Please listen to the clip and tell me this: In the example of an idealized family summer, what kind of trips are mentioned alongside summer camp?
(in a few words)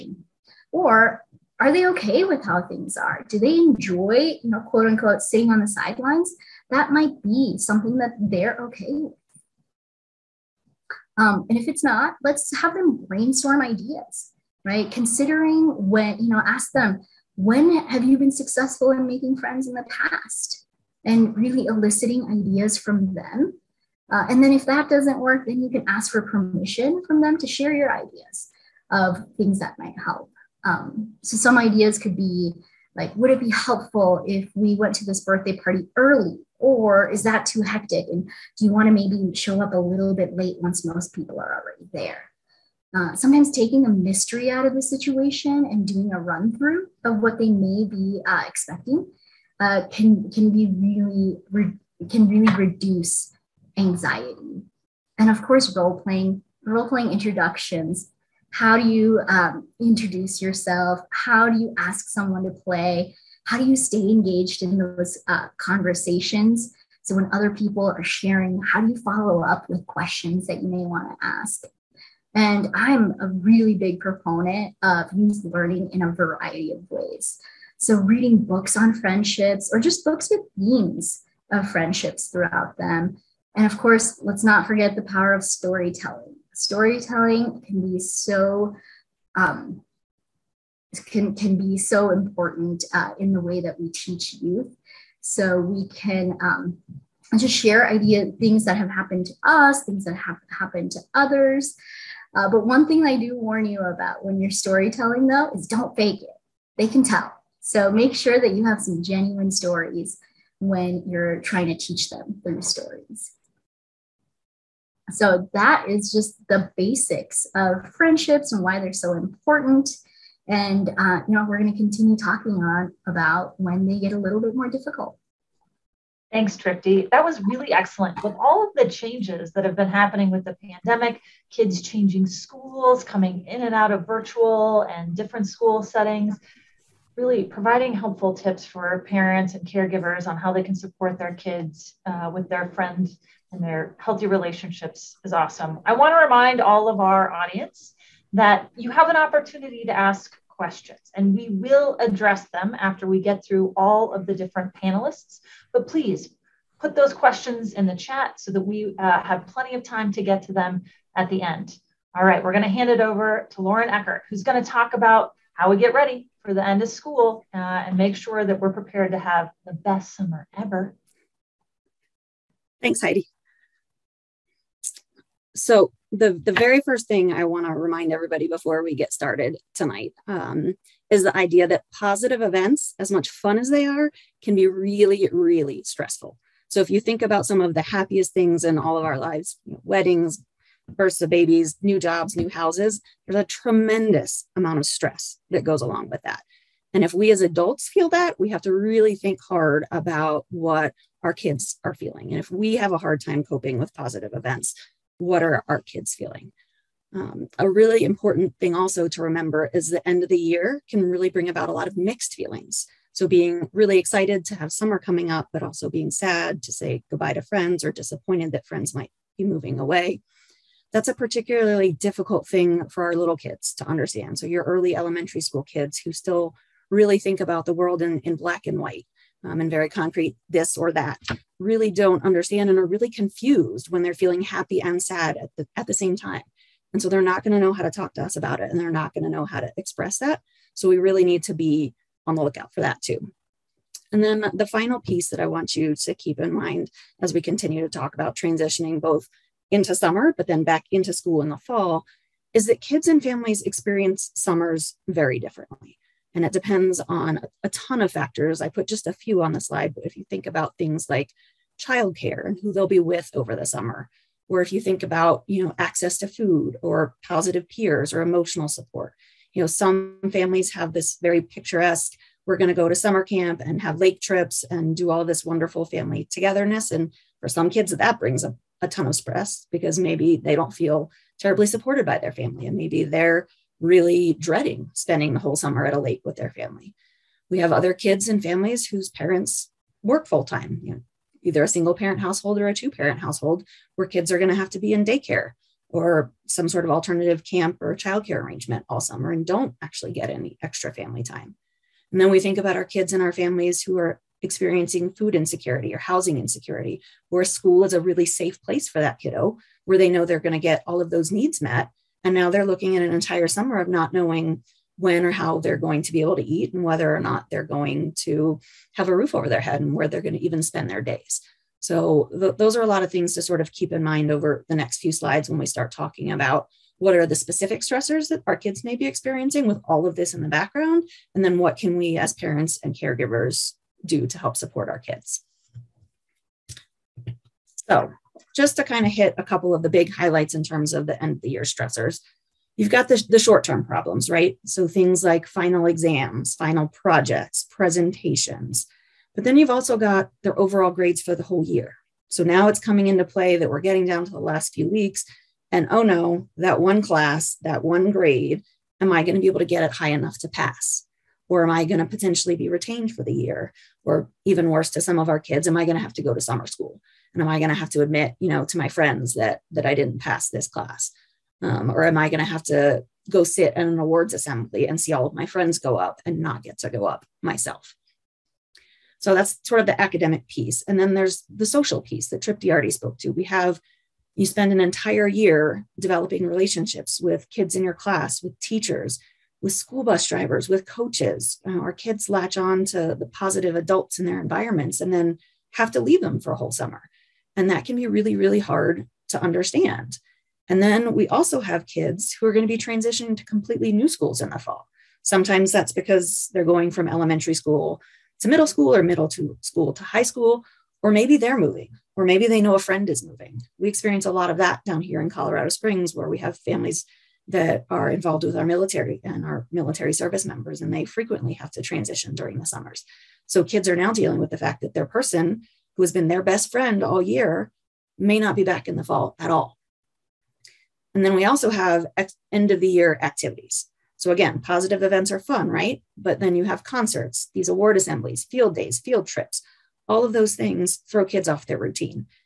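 Lake trips.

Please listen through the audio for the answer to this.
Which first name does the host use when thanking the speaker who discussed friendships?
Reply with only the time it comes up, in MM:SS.
02:06.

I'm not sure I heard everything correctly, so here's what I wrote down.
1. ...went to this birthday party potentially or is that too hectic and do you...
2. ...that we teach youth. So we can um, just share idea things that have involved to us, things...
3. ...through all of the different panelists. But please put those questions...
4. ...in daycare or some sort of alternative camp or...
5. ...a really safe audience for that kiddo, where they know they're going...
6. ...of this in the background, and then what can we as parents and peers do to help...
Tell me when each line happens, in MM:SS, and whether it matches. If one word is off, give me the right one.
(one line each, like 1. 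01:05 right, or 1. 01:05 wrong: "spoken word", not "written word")
1. 00:34 wrong: "early", not "potentially"
2. 01:33 wrong: "happened", not "involved"
3. 02:33 right
4. 04:54 right
5. 05:07 wrong: "place", not "audience"
6. 05:30 wrong: "caregivers", not "peers".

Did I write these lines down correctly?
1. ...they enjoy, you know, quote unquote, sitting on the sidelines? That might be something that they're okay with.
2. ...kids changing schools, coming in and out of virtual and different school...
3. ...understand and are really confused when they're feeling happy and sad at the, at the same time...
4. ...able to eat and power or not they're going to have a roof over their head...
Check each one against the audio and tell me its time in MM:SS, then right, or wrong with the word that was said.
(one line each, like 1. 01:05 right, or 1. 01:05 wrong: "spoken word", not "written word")
1. 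00:03 right
2. 02:11 right
3. 03:52 right
4. 05:16 wrong: "whether", not "power".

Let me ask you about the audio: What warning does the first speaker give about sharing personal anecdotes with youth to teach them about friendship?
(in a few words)
Don't fake it.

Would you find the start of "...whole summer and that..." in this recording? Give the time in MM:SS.
06:36.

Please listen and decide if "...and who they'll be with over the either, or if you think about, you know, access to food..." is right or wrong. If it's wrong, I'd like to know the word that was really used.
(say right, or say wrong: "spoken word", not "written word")
wrong: "summer", not "either".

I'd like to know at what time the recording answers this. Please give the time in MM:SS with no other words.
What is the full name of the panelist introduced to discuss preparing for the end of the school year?
02:43.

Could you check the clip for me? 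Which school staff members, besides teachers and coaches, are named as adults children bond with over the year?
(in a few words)
School bus drivers.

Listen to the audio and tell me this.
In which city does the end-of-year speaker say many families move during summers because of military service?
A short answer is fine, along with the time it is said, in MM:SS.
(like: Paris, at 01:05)
Colorado Springs, at 06:55.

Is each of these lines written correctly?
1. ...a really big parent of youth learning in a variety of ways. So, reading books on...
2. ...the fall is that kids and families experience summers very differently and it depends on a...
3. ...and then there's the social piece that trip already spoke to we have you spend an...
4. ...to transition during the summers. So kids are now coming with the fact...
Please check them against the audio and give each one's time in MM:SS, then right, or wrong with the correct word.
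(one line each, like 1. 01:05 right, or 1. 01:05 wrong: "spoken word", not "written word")
1. 01:13 wrong: "proponent", not "parent"
2. 04:11 right
3. 06:20 right
4. 07:01 wrong: "dealing", not "coming".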